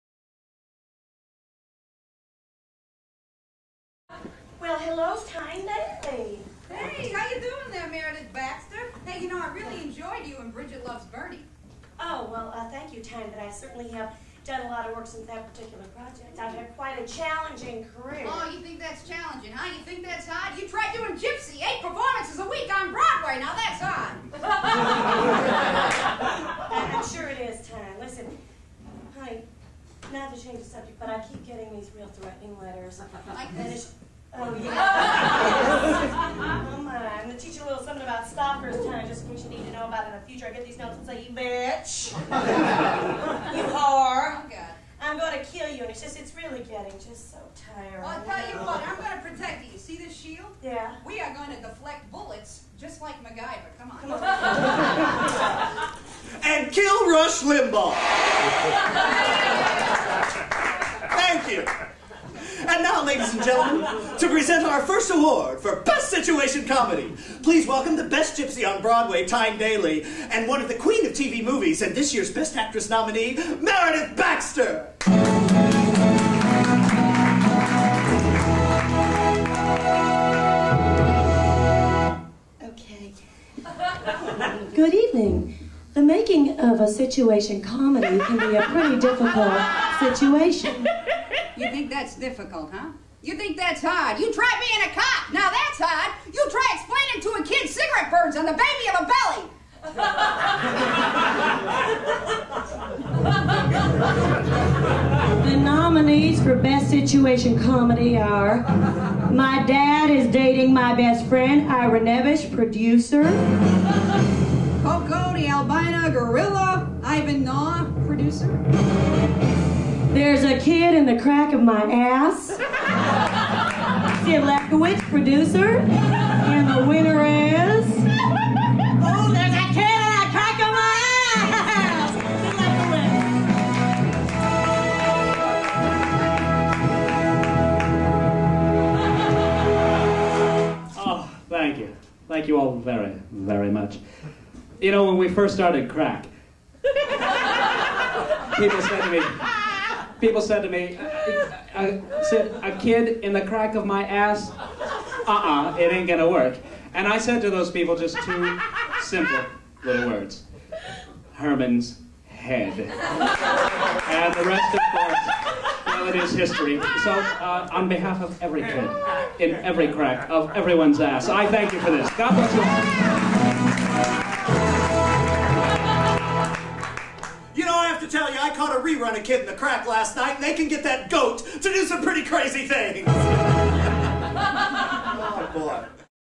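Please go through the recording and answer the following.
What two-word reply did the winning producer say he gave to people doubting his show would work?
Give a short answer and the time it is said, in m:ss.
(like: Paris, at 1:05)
Herman's Head, at 2:41.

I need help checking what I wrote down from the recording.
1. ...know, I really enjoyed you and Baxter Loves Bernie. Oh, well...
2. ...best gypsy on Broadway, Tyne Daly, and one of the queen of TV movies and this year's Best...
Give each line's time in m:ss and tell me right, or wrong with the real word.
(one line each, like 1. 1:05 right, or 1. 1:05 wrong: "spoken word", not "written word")
1. 0:09 wrong: "Bridget", not "Baxter"
2. 1:08 right.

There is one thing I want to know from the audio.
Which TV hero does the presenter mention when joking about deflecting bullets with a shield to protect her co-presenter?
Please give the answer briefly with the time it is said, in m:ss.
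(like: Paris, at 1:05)
MacGyver, at 0:53.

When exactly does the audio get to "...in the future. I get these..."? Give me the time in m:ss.
0:40.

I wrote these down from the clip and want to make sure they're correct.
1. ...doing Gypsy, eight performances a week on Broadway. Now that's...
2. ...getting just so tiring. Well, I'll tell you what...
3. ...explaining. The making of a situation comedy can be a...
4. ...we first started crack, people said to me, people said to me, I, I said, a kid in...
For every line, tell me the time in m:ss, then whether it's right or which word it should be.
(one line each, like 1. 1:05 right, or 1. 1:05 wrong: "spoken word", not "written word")
1. 0:20 right
2. 0:46 right
3. 1:24 wrong: "evening", not "explaining"
4. 2:25 right.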